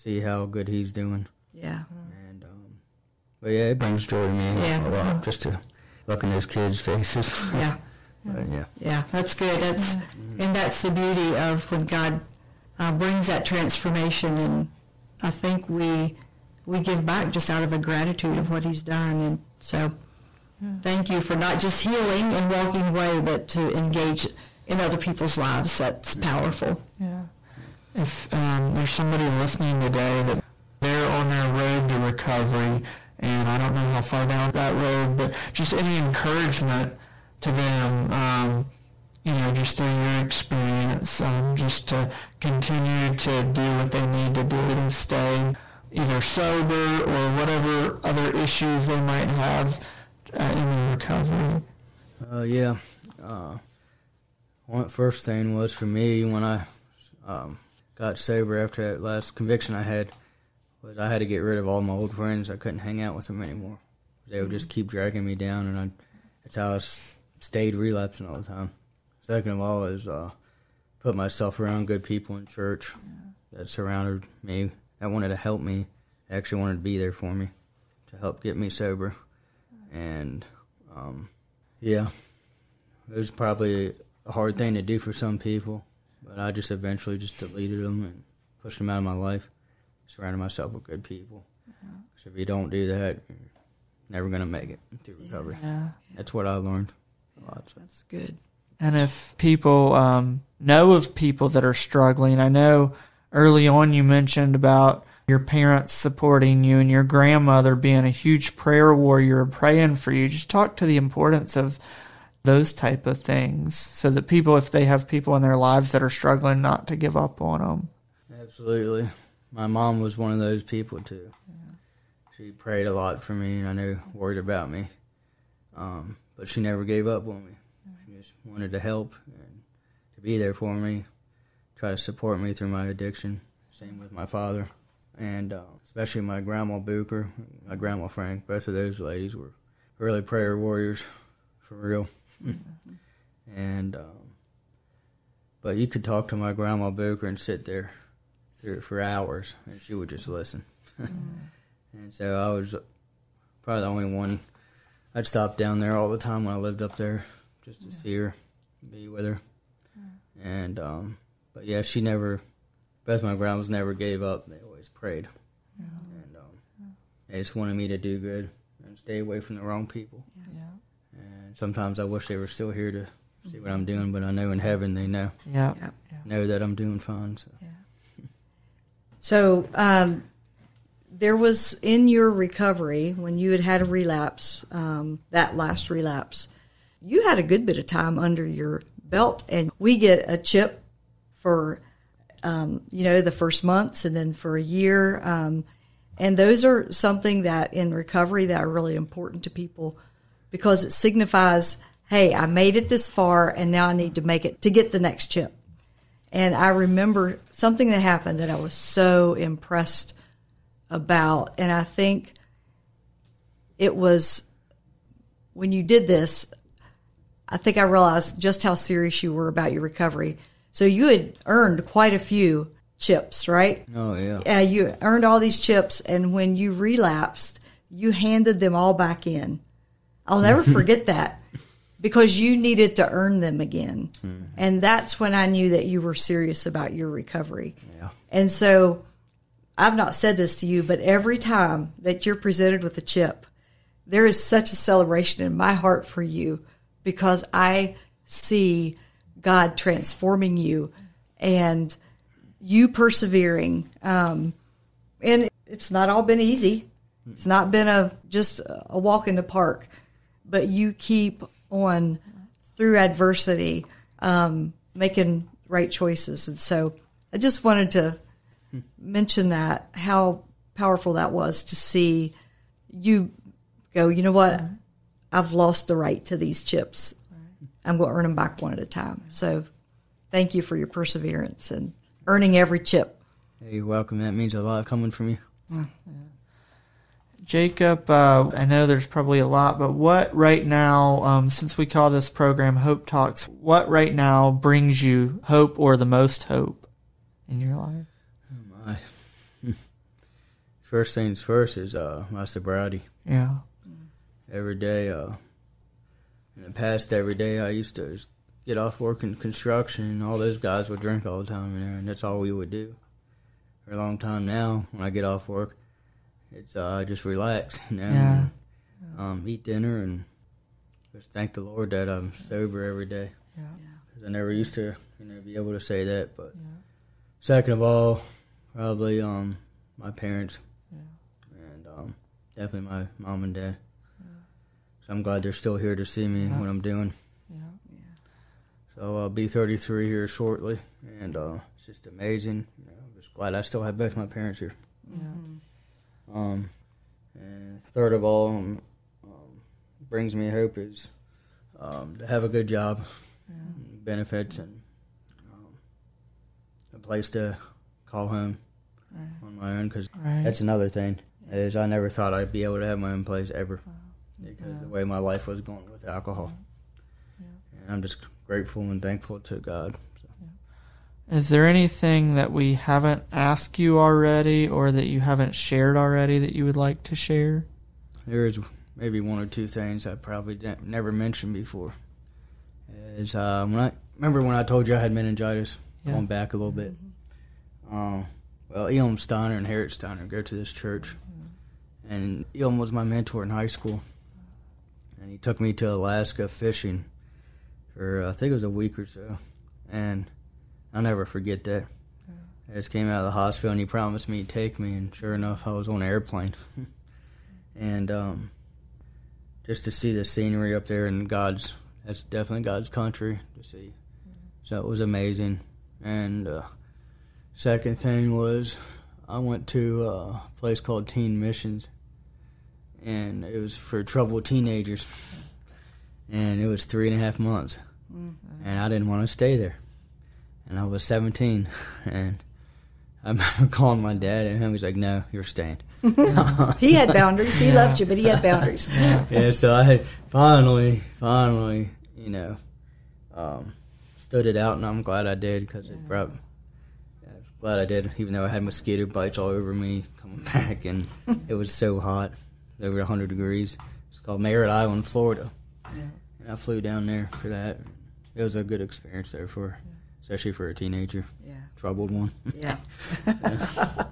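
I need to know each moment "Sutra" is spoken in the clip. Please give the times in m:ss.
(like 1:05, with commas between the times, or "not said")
not said.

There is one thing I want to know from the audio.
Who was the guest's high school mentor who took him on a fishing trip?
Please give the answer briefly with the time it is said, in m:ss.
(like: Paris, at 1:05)
Elam Steiner, at 6:28.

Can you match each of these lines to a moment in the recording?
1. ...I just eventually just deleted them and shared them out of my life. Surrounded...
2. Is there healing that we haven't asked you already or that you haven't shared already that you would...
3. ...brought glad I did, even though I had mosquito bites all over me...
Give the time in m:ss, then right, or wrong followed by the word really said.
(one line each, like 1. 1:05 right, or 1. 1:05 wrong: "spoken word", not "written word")
1. 1:26 wrong: "pushed", not "shared"
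2. 6:11 wrong: "anything", not "healing"
3. 7:26 right.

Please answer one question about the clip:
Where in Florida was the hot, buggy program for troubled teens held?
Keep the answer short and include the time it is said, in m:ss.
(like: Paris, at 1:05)
Merritt Island, at 7:34.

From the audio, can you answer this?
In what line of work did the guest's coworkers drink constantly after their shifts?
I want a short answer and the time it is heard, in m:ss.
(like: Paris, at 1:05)
Construction, at 5:09.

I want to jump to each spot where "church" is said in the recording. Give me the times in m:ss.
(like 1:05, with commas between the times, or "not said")
1:12, 6:30.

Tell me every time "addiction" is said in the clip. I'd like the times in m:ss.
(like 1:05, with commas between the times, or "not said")
2:12.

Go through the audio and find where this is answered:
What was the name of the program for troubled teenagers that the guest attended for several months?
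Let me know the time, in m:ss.
7:01.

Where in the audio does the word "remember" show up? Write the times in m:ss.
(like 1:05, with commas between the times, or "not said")
3:26, 6:24, 7:13.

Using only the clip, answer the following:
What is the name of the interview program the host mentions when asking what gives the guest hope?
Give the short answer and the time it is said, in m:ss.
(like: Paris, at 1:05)
Hope Talks, at 4:52.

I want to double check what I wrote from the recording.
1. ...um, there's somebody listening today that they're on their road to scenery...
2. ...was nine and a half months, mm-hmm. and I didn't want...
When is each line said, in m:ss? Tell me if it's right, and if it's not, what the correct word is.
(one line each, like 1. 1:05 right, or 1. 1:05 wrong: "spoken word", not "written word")
1. 0:28 wrong: "recovery", not "scenery"
2. 7:06 wrong: "three", not "nine".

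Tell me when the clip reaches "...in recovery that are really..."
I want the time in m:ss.
3:17.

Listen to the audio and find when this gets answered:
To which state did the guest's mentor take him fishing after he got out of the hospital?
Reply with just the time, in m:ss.
6:35.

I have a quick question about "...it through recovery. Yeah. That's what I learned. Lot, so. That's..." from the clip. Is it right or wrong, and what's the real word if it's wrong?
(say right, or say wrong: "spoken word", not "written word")
right.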